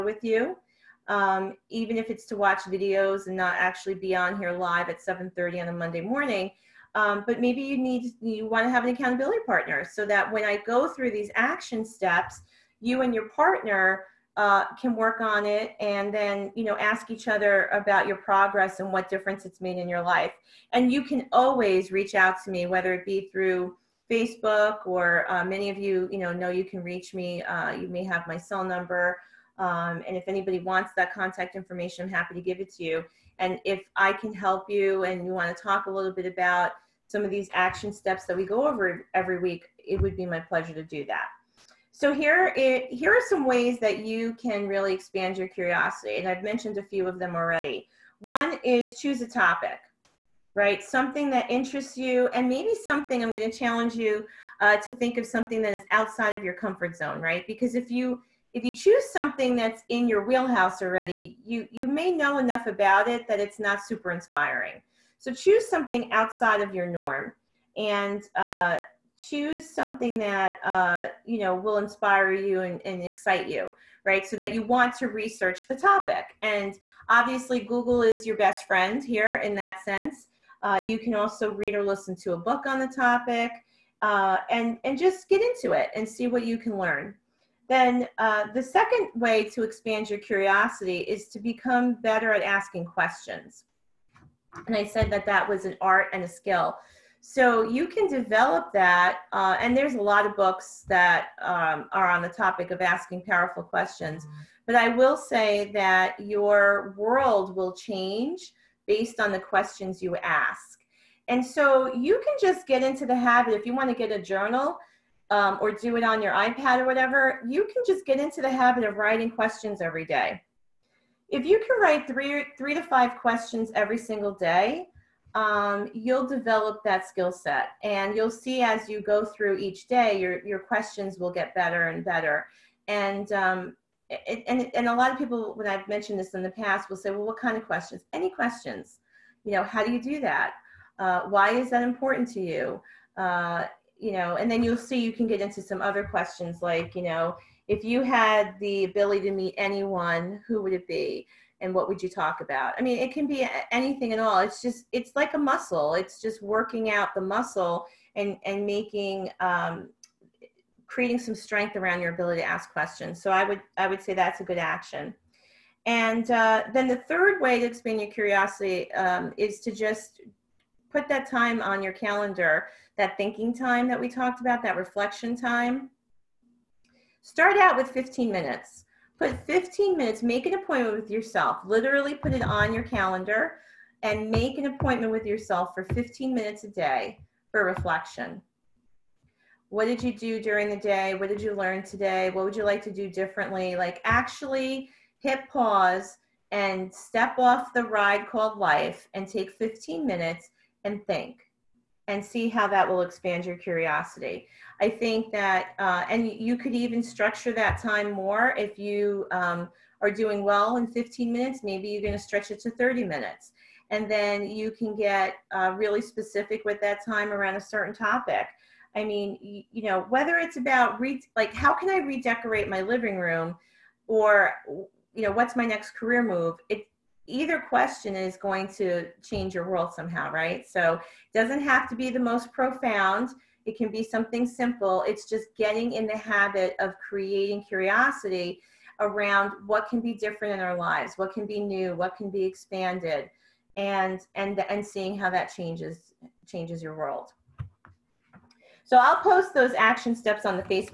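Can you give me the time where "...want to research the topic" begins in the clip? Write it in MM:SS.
01:14.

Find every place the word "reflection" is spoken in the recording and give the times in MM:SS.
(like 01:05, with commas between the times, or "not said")
02:54, 03:07.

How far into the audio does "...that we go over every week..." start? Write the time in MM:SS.
00:38.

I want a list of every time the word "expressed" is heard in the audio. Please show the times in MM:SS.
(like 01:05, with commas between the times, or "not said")
not said.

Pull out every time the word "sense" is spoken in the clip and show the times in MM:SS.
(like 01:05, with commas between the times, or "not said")
01:19.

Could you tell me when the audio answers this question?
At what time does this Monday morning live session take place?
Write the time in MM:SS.
00:04.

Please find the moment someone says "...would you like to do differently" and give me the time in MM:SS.
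03:12.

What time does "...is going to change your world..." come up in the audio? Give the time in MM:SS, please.
03:48.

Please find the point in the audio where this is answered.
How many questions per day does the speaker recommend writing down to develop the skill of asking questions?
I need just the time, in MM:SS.
02:02.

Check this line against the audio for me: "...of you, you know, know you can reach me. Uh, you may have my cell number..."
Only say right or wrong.
right.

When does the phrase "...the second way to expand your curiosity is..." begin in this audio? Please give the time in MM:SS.
01:28.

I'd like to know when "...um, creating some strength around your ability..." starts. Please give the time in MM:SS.
02:39.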